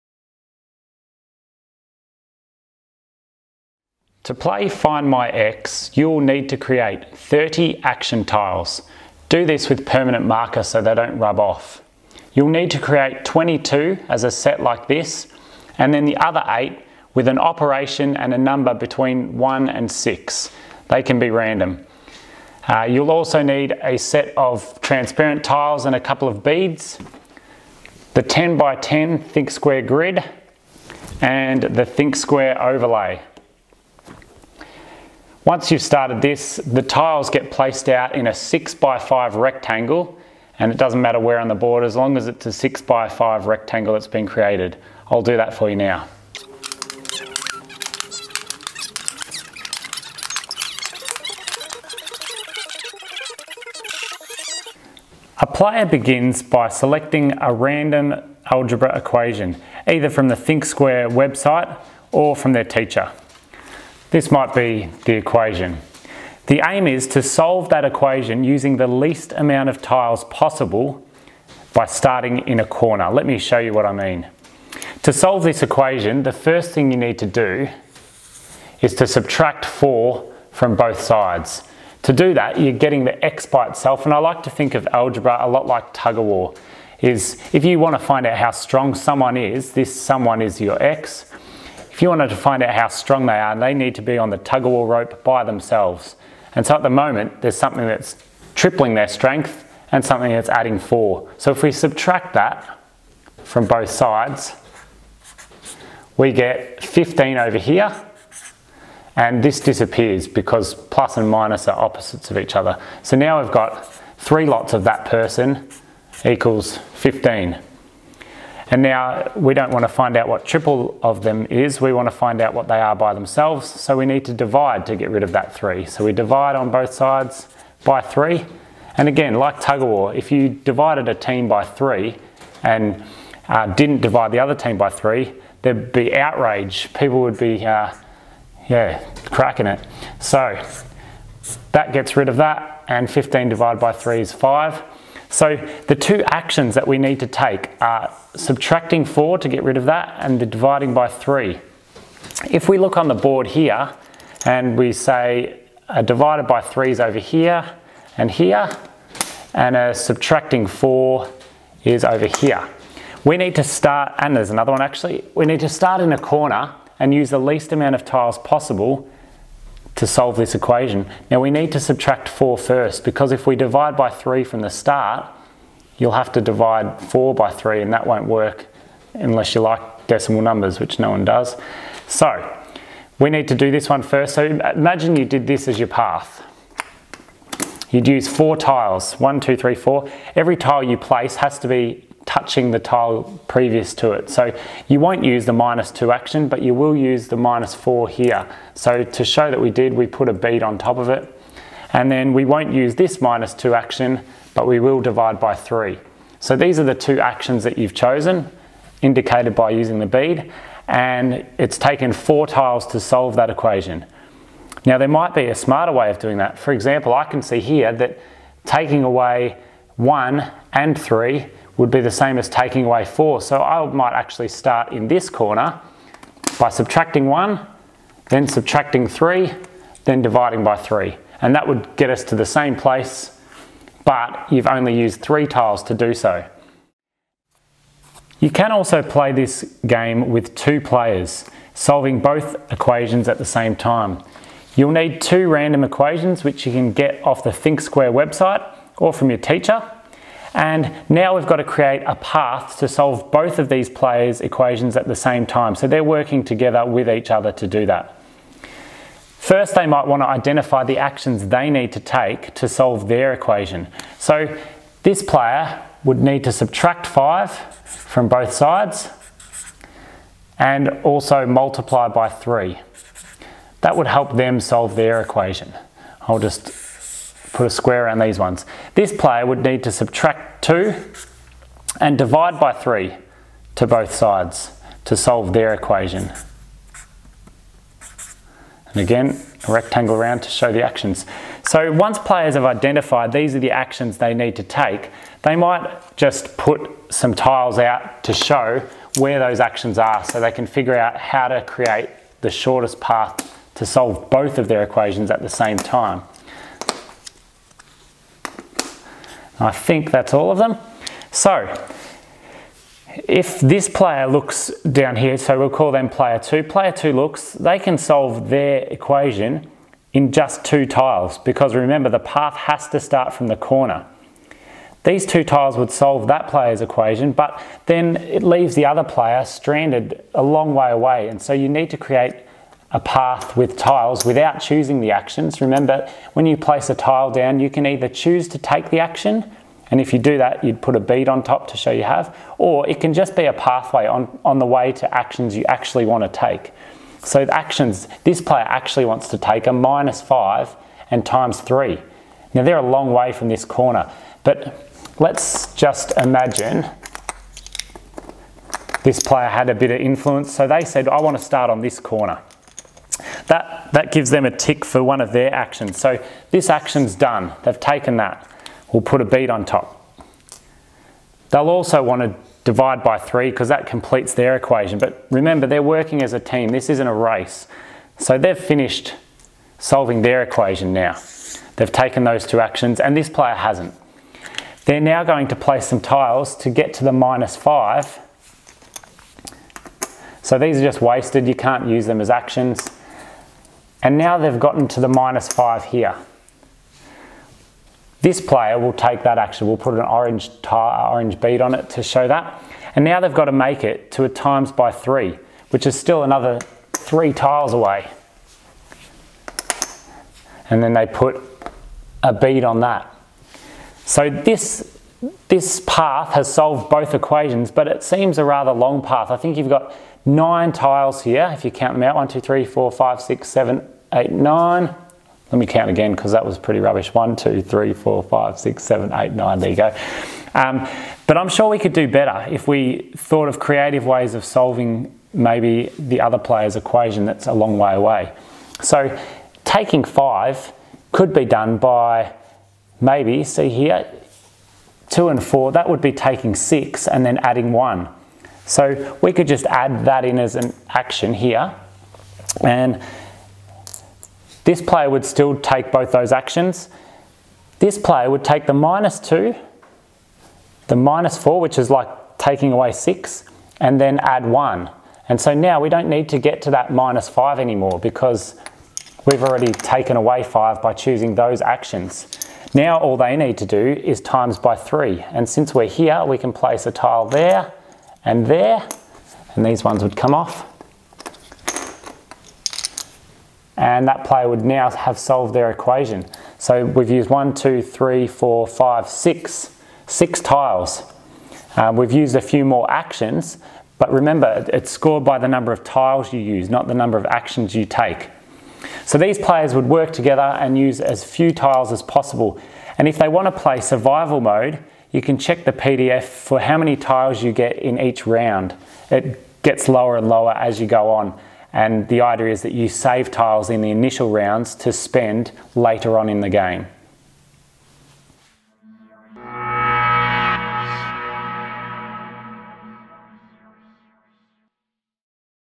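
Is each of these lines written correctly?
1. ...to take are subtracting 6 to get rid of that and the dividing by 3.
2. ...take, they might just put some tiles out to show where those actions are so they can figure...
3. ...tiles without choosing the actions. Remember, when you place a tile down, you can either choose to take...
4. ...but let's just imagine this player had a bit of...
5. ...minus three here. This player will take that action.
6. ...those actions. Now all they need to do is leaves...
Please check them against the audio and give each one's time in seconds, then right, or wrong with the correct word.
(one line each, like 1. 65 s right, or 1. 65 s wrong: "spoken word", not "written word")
1. 147 s wrong: "4", not "6"
2. 294 s right
3. 333 s right
4. 354 s right
5. 395 s wrong: "five", not "three"
6. 471 s wrong: "times", not "leaves".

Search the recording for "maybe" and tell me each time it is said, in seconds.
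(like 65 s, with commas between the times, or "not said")
435 s, 442 s.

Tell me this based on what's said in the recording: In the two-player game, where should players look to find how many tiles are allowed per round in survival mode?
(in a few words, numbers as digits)
the PDF.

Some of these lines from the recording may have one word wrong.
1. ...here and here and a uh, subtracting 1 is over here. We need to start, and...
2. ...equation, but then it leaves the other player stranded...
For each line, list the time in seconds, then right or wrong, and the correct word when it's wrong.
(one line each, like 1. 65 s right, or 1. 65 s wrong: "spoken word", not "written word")
1. 157 s wrong: "4", not "1"
2. 326 s right.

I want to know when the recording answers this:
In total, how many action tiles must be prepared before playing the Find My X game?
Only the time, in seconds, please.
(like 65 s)
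7 s.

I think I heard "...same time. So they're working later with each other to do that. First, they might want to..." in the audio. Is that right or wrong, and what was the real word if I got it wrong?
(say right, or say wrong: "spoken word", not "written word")
wrong: "together", not "later".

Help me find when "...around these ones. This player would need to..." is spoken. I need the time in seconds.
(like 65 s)
278 s.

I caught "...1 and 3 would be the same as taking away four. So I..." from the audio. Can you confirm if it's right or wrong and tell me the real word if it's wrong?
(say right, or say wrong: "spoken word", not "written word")
right.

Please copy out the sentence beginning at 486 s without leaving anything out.
So we've used one, two, three, four, five, six, six tiles.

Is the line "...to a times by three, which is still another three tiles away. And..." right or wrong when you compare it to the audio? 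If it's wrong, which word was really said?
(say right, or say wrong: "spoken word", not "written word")
right.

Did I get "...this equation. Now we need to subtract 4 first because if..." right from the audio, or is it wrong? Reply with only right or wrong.
right.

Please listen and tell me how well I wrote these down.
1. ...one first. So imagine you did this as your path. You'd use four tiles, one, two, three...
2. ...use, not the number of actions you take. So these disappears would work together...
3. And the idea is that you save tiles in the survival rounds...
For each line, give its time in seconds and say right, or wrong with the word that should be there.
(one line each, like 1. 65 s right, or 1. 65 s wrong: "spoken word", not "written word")
1. 183 s right
2. 496 s wrong: "players", not "disappears"
3. 511 s wrong: "initial", not "survival".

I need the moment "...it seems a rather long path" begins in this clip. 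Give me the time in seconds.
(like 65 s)
417 s.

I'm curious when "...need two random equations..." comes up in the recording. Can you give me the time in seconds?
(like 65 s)
244 s.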